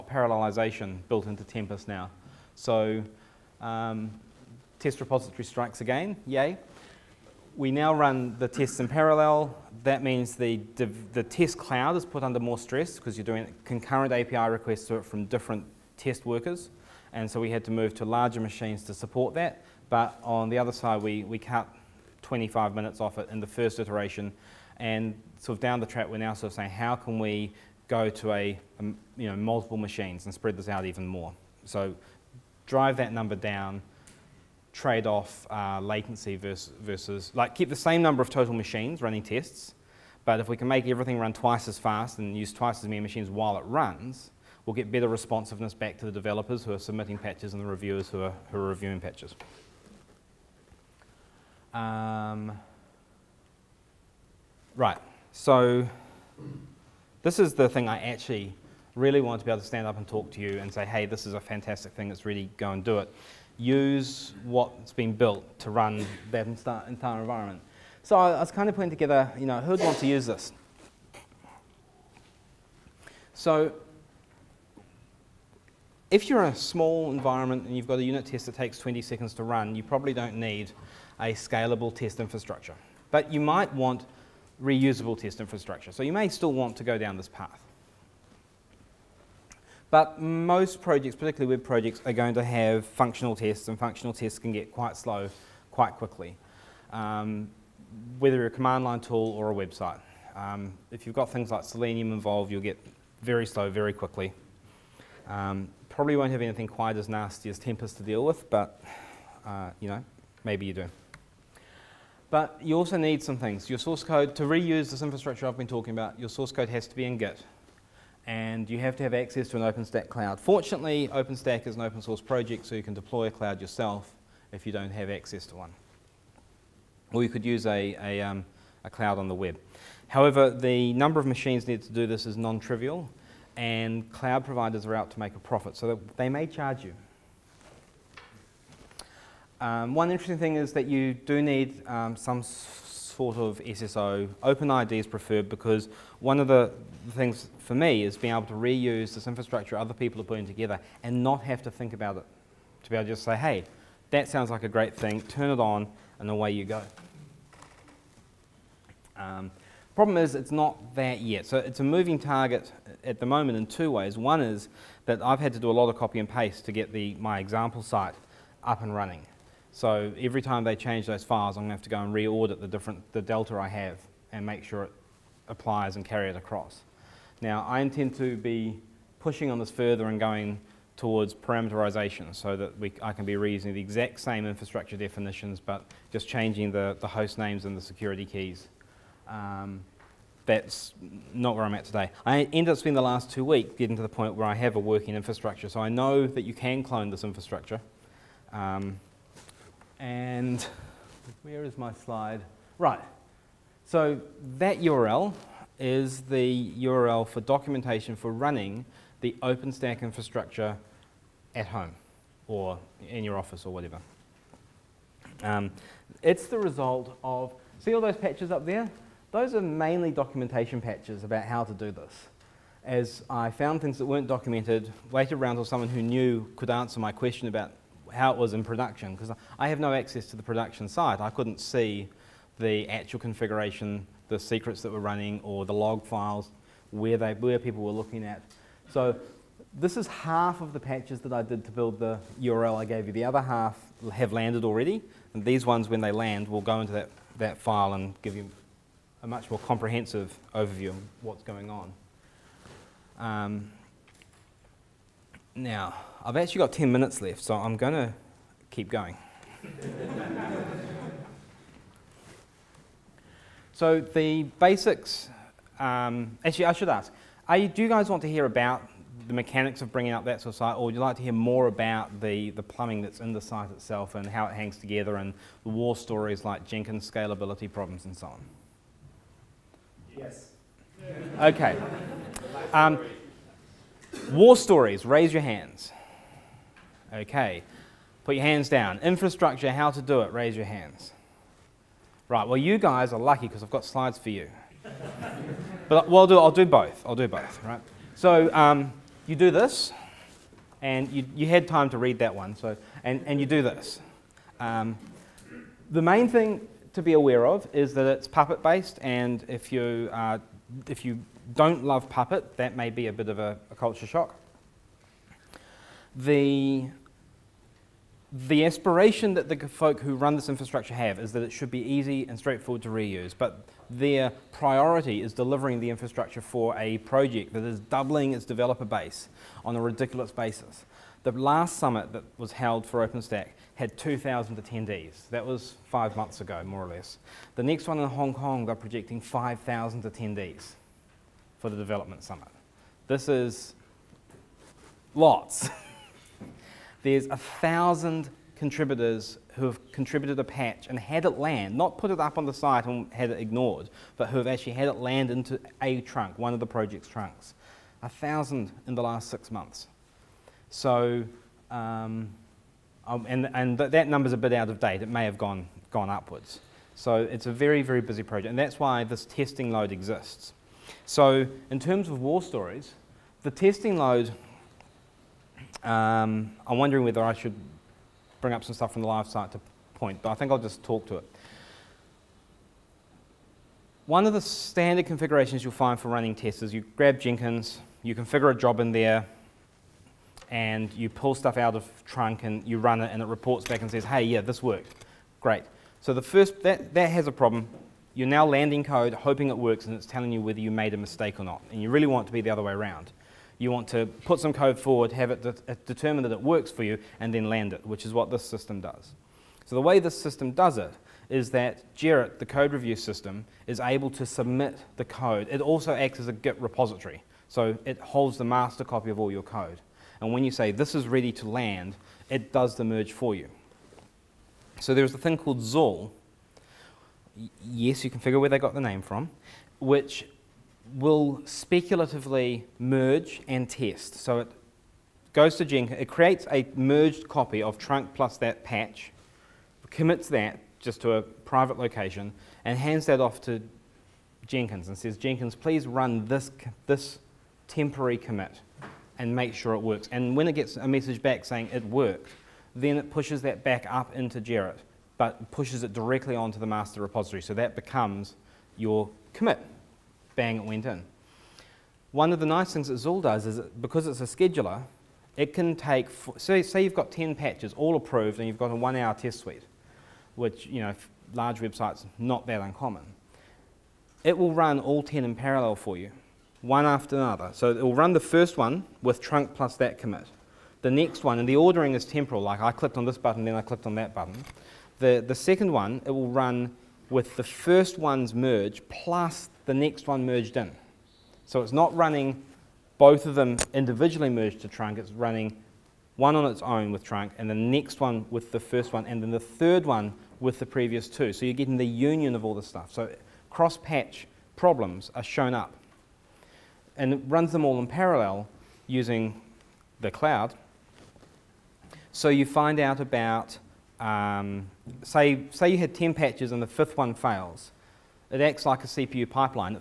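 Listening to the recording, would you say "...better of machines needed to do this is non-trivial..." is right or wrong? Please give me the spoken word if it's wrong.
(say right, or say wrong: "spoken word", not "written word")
wrong: "number", not "better".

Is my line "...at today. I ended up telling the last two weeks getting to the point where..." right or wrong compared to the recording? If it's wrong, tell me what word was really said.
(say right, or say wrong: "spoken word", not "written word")
wrong: "spending", not "telling".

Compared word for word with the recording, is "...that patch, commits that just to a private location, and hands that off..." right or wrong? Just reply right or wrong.
right.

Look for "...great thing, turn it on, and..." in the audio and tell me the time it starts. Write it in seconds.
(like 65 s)
154 s.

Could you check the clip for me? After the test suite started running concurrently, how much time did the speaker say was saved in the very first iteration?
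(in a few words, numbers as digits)
25 minutes.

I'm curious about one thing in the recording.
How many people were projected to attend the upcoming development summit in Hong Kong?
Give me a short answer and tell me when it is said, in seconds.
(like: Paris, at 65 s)
5,000, at 339 s.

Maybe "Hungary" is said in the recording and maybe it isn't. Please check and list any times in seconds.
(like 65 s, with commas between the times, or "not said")
not said.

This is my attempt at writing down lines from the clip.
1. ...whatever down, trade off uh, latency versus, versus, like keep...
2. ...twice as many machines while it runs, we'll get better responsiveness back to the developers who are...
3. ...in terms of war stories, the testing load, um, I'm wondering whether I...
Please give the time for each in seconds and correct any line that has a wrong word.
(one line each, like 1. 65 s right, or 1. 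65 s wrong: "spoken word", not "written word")
1. 33 s wrong: "number", not "whatever"
2. 42 s right
3. 371 s right.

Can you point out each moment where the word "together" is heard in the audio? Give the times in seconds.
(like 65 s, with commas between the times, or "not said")
68 s, 150 s, 274 s.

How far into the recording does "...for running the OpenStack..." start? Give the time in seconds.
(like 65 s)
208 s.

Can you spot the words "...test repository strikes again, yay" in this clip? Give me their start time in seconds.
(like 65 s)
4 s.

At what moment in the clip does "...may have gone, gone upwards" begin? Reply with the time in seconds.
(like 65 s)
365 s.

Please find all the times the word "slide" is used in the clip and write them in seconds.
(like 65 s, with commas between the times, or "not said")
201 s, 293 s.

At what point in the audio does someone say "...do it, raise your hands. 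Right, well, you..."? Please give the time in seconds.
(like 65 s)
290 s.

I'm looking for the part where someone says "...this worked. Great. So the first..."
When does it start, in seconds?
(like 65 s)
394 s.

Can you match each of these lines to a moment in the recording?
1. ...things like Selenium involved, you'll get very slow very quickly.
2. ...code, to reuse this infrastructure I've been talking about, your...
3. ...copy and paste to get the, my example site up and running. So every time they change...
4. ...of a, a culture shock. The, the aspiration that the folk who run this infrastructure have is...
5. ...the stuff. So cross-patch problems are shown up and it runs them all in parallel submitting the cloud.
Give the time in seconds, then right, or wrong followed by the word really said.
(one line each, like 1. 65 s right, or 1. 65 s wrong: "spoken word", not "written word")
1. 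101 s right
2. 114 s right
3. 165 s right
4. 313 s right
5. 502 s wrong: "using", not "submitting".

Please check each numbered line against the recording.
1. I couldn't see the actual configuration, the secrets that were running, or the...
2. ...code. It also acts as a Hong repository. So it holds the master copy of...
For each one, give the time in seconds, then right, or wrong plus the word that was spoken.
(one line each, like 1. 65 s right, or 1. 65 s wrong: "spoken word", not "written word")
1. 231 s right
2. 415 s wrong: "Git", not "Hong".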